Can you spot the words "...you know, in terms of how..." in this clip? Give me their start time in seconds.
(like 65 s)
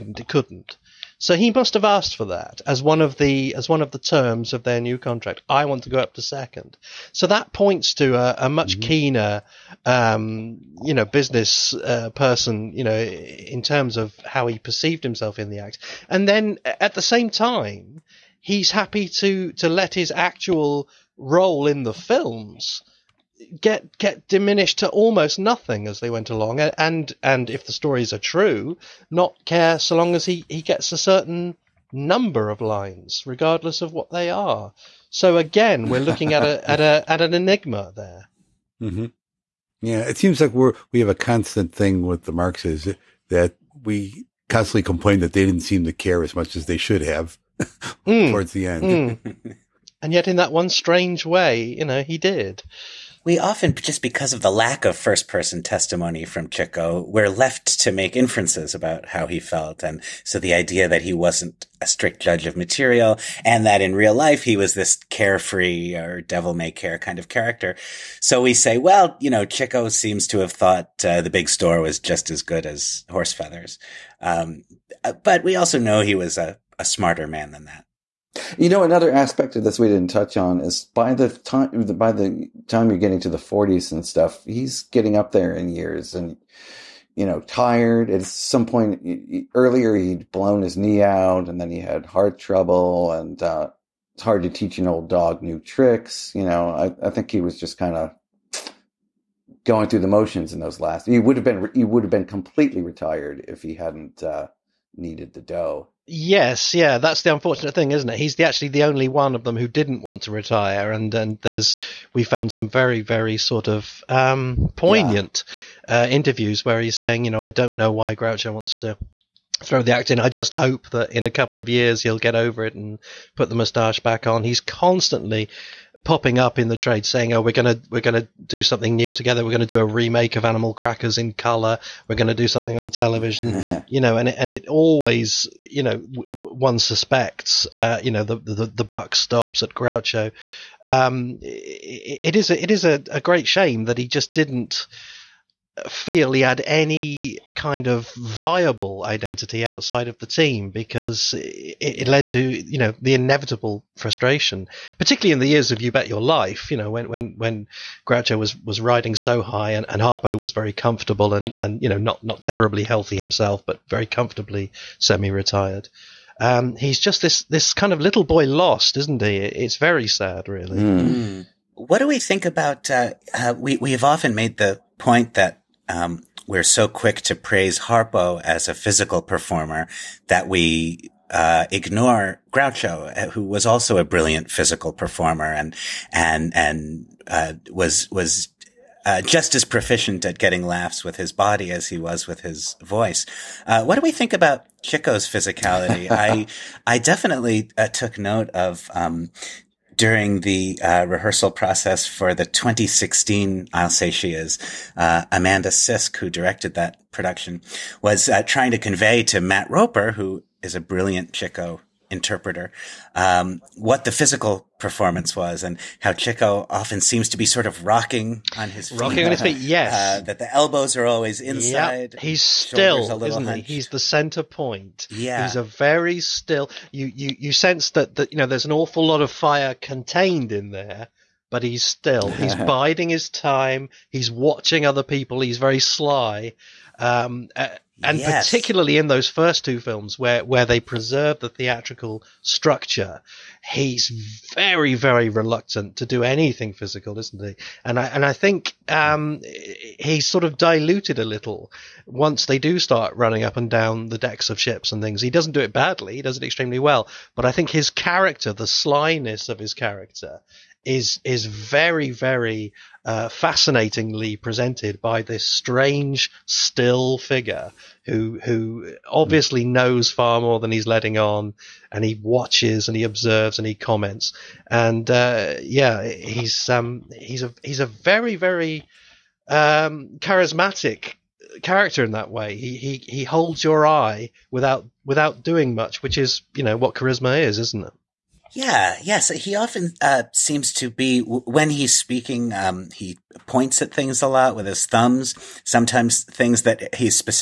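12 s.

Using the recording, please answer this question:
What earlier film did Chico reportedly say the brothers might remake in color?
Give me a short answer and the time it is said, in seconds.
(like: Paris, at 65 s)
Animal Crackers, at 130 s.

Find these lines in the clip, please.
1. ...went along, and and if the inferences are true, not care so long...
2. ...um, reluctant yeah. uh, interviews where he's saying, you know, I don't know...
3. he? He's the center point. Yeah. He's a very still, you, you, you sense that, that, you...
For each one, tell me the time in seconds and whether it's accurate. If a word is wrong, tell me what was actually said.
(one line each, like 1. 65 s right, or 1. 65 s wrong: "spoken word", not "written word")
1. 26 s wrong: "stories", not "inferences"
2. 114 s wrong: "poignant", not "reluctant"
3. 223 s right.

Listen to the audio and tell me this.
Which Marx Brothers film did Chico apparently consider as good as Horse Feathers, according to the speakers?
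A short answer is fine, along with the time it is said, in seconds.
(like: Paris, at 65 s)
The Big Store, at 71 s.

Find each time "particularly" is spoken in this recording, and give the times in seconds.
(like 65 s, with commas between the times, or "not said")
154 s, 238 s.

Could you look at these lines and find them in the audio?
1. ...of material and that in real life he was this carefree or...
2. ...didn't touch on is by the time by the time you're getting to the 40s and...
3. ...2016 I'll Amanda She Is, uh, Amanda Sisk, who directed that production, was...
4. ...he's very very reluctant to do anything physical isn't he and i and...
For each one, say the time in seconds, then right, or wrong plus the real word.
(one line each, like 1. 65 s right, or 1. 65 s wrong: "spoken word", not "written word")
1. 62 s right
2. 79 s right
3. 202 s wrong: "Say", not "Amanda"
4. 243 s right.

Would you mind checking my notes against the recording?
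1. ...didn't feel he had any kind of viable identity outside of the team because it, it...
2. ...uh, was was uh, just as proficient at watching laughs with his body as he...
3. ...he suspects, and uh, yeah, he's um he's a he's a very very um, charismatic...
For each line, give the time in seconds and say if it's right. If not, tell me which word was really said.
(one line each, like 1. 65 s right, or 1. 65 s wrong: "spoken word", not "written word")
1. 144 s right
2. 187 s wrong: "getting", not "watching"
3. 273 s wrong: "comments", not "suspects".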